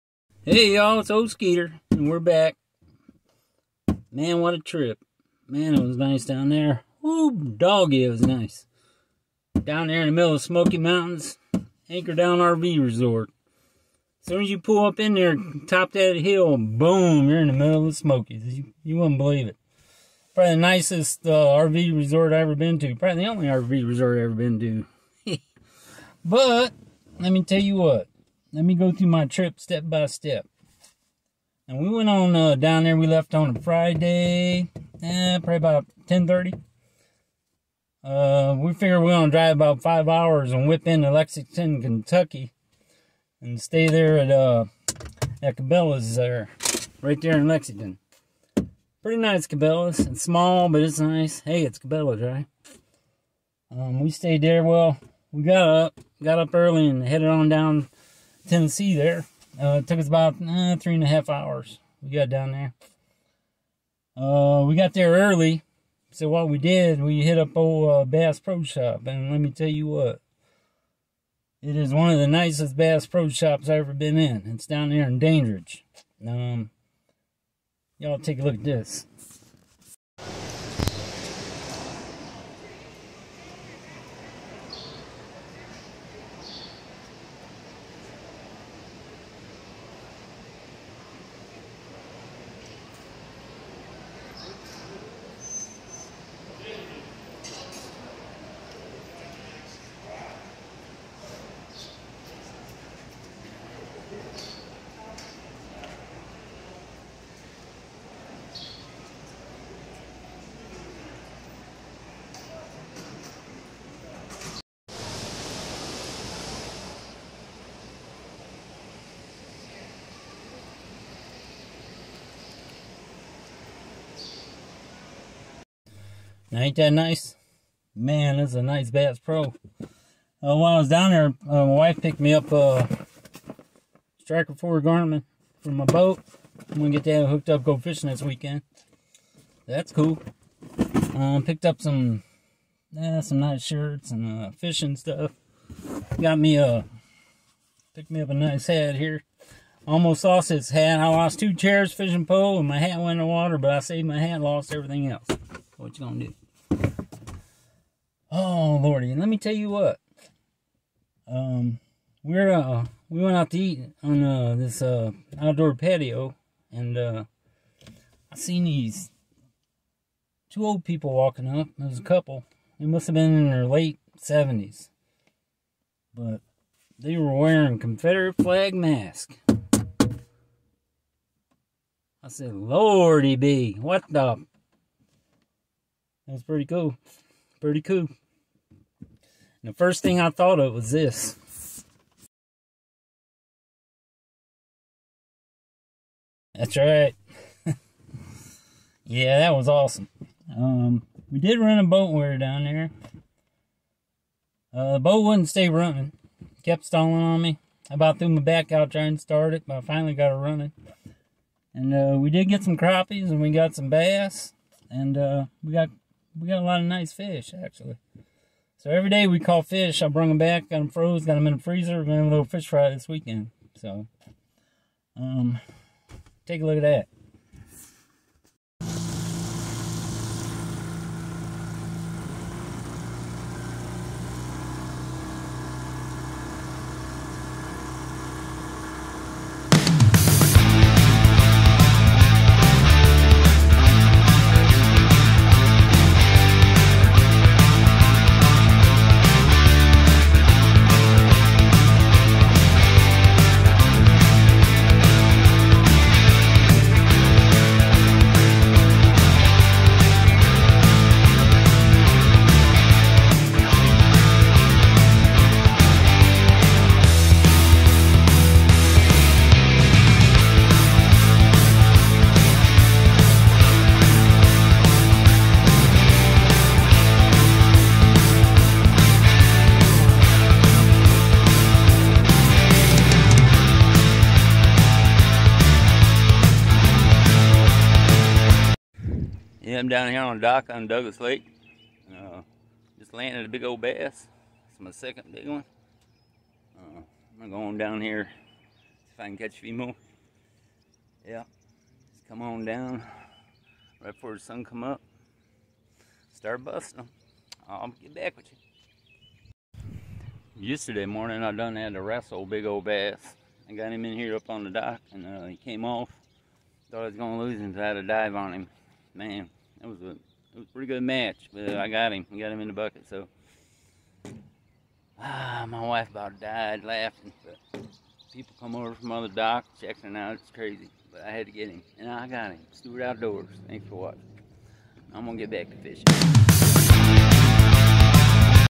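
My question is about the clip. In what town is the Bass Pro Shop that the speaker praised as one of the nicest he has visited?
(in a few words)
Dandridge.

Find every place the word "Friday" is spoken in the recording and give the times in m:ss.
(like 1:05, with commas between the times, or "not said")
0:33.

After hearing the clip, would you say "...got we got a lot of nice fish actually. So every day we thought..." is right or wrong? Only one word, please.
wrong.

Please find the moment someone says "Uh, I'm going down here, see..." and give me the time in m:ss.
4:56.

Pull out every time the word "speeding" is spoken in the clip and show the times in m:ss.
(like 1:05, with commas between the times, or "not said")
not said.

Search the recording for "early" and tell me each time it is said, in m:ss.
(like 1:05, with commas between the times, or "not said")
0:56, 1:05.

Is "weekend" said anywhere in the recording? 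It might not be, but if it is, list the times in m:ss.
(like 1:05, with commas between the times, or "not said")
2:18, 3:43.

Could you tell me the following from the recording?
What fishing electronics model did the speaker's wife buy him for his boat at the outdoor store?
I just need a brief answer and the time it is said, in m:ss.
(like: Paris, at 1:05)
Striker 4 Garmin, at 2:14.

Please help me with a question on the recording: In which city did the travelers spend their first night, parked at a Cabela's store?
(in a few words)
Lexington, Kentucky.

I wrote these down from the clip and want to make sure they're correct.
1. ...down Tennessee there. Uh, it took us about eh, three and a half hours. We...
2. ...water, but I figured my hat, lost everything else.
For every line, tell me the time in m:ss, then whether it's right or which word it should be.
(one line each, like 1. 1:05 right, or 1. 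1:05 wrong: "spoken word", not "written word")
1. 0:57 right
2. 2:33 wrong: "saved", not "figured".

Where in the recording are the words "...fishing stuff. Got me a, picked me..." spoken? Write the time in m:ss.
2:24.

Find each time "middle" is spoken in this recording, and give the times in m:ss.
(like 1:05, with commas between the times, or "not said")
0:10, 0:17.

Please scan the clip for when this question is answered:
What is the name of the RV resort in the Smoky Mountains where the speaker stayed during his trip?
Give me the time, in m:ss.
0:11.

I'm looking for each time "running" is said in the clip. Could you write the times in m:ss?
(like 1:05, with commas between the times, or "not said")
3:25, 3:30.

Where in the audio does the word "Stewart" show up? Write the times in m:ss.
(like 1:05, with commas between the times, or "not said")
5:32.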